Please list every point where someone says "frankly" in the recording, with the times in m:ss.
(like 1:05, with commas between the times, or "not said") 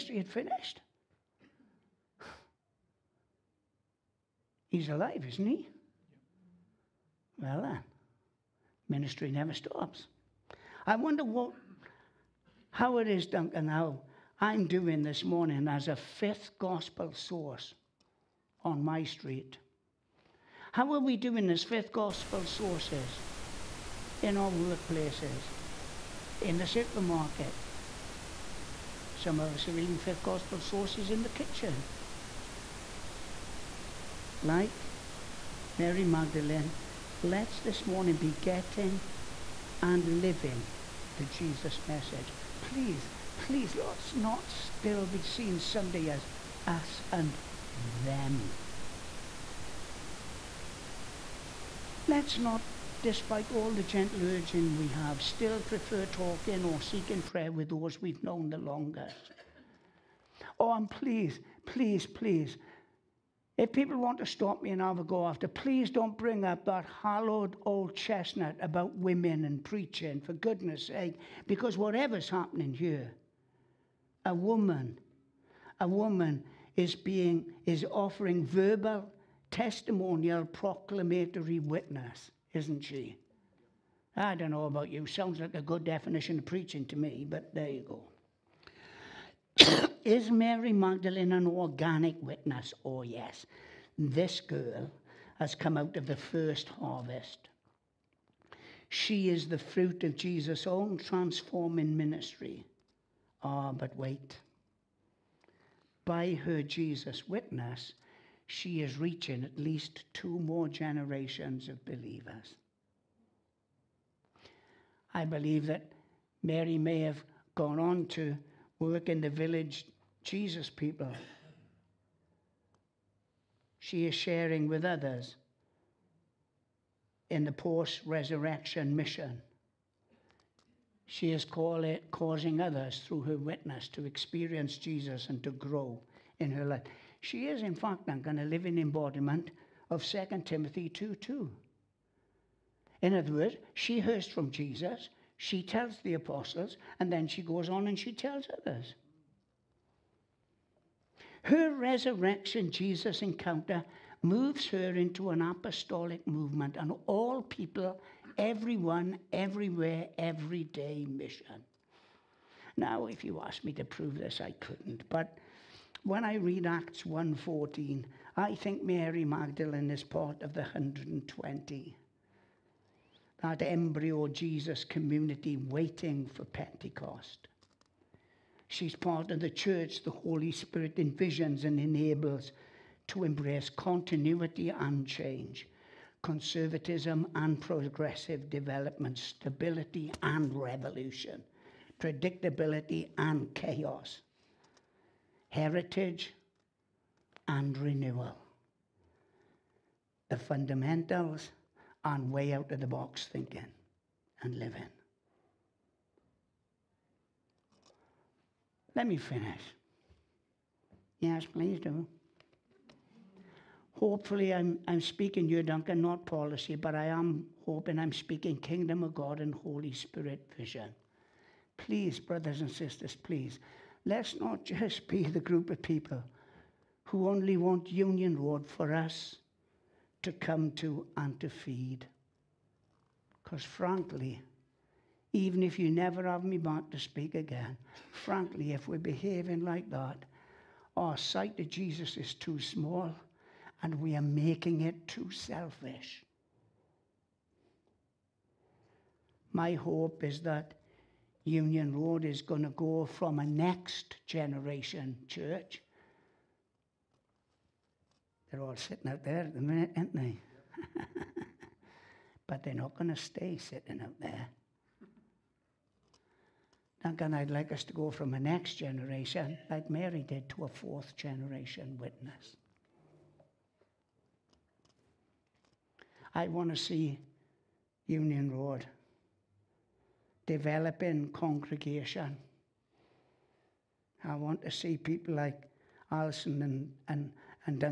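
3:53, 3:58.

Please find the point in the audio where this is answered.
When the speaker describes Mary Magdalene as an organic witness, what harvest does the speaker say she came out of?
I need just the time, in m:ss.
1:36.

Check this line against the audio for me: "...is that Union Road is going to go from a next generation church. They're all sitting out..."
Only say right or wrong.
right.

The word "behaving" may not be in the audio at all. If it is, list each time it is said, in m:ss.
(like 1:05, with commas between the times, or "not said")
3:58.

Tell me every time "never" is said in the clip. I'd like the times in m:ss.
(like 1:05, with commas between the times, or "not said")
0:09, 3:55.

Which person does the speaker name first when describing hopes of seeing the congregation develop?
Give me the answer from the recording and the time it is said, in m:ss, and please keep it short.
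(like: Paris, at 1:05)
Alison, at 4:46.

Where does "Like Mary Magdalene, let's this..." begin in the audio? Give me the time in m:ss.
0:34.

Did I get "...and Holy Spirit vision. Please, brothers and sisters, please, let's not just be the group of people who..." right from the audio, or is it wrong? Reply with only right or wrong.
right.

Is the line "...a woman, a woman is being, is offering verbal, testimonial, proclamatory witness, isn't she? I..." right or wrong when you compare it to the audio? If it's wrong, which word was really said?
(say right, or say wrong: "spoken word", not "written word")
right.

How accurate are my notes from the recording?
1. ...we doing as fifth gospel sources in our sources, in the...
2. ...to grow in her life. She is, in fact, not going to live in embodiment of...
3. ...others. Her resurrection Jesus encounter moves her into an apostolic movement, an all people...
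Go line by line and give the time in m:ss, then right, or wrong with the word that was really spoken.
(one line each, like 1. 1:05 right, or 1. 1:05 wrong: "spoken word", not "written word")
1. 0:20 wrong: "workplaces", not "sources"
2. 2:15 right
3. 2:28 right.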